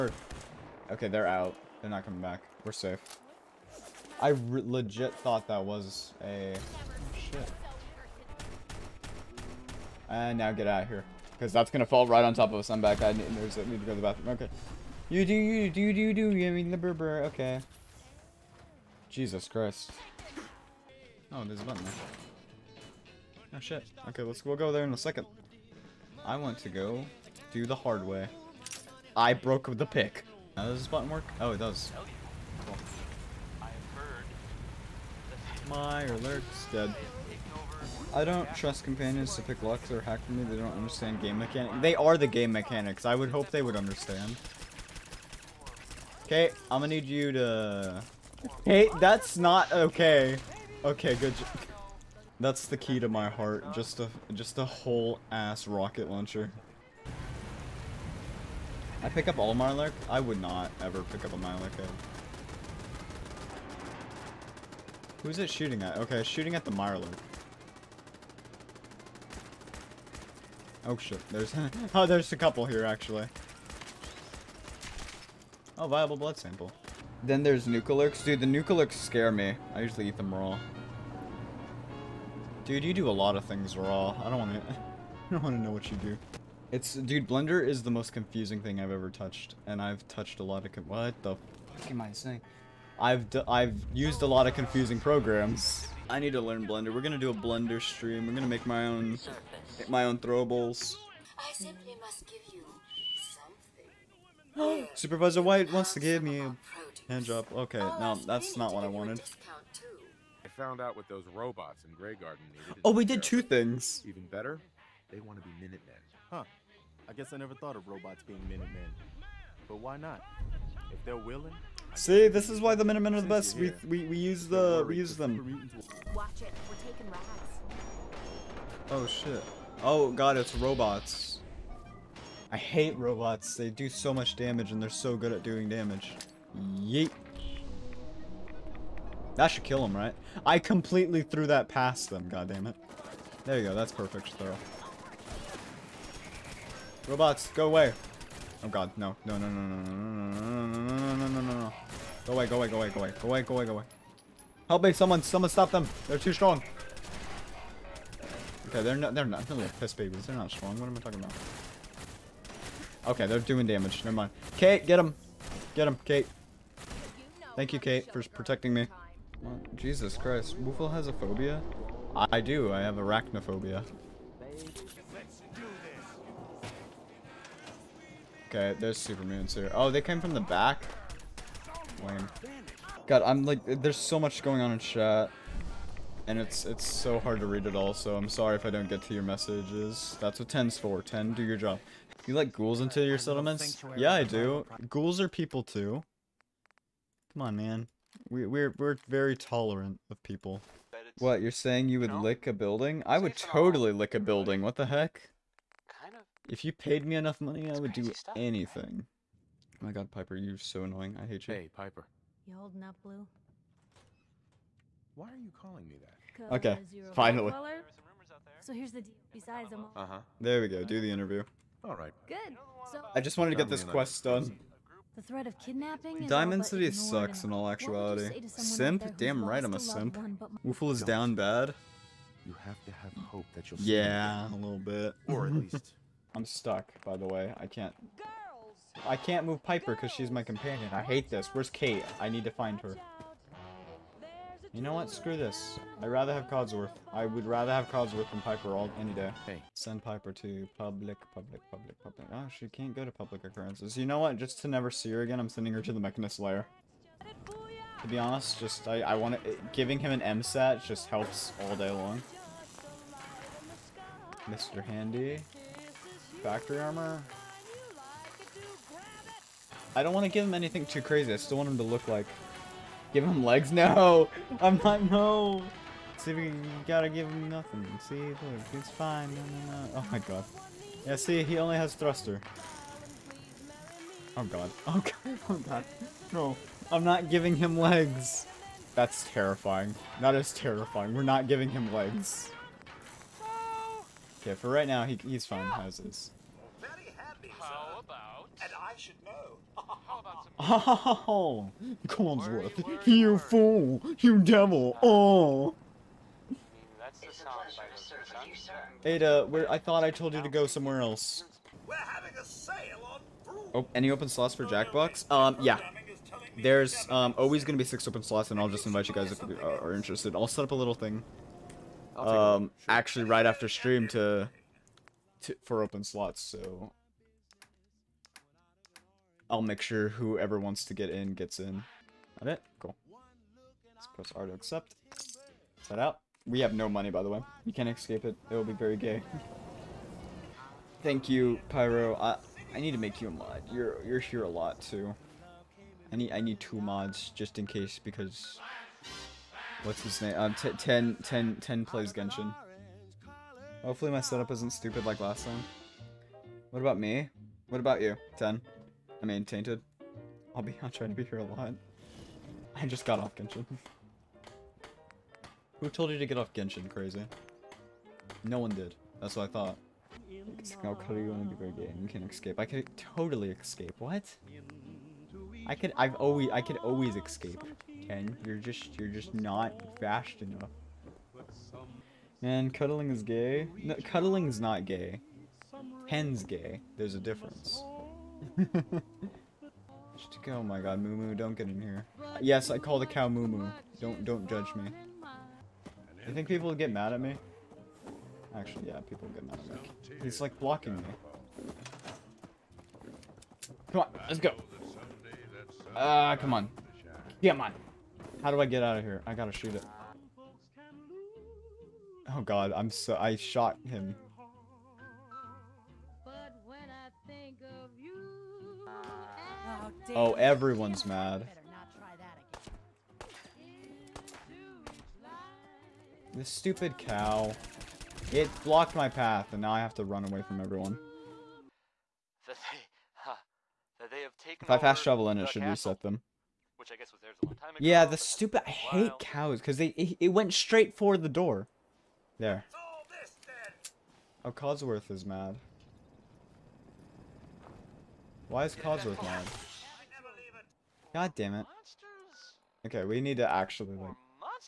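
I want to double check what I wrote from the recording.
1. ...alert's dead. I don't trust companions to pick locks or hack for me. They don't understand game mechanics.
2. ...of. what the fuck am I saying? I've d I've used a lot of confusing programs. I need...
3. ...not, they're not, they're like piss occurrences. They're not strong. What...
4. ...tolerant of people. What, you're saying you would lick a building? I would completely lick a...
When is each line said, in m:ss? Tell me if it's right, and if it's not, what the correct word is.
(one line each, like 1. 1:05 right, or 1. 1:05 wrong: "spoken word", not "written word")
1. 0:36 right
2. 1:30 right
3. 2:38 wrong: "babies", not "occurrences"
4. 3:19 wrong: "totally", not "completely".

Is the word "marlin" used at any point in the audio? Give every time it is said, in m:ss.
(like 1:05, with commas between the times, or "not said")
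1:01, 1:06.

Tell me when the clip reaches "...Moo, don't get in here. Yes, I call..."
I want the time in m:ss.
6:31.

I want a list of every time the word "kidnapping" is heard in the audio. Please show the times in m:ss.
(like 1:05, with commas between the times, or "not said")
3:45.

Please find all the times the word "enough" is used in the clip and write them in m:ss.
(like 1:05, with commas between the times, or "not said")
3:27, 6:20.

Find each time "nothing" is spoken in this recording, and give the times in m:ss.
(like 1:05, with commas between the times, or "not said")
4:37.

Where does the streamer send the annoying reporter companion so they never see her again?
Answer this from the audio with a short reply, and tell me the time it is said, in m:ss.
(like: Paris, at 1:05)
the Mechanist Lair, at 4:16.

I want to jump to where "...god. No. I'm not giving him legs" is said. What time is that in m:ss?
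4:45.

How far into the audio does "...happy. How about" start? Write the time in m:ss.
4:57.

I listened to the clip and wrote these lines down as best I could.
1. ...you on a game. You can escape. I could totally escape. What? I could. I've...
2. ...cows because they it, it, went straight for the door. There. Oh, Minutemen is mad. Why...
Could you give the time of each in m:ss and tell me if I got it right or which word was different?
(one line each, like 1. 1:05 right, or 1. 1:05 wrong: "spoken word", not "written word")
1. 6:11 right
2. 7:19 wrong: "Codsworth", not "Minutemen".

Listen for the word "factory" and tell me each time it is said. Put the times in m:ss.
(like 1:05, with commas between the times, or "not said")
4:26.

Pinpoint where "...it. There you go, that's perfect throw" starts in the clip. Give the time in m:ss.
2:22.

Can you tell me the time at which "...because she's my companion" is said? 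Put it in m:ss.
3:59.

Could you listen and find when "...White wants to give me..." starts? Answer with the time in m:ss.
1:45.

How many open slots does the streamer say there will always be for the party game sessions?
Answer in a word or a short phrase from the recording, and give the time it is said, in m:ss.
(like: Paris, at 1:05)
6, at 5:17.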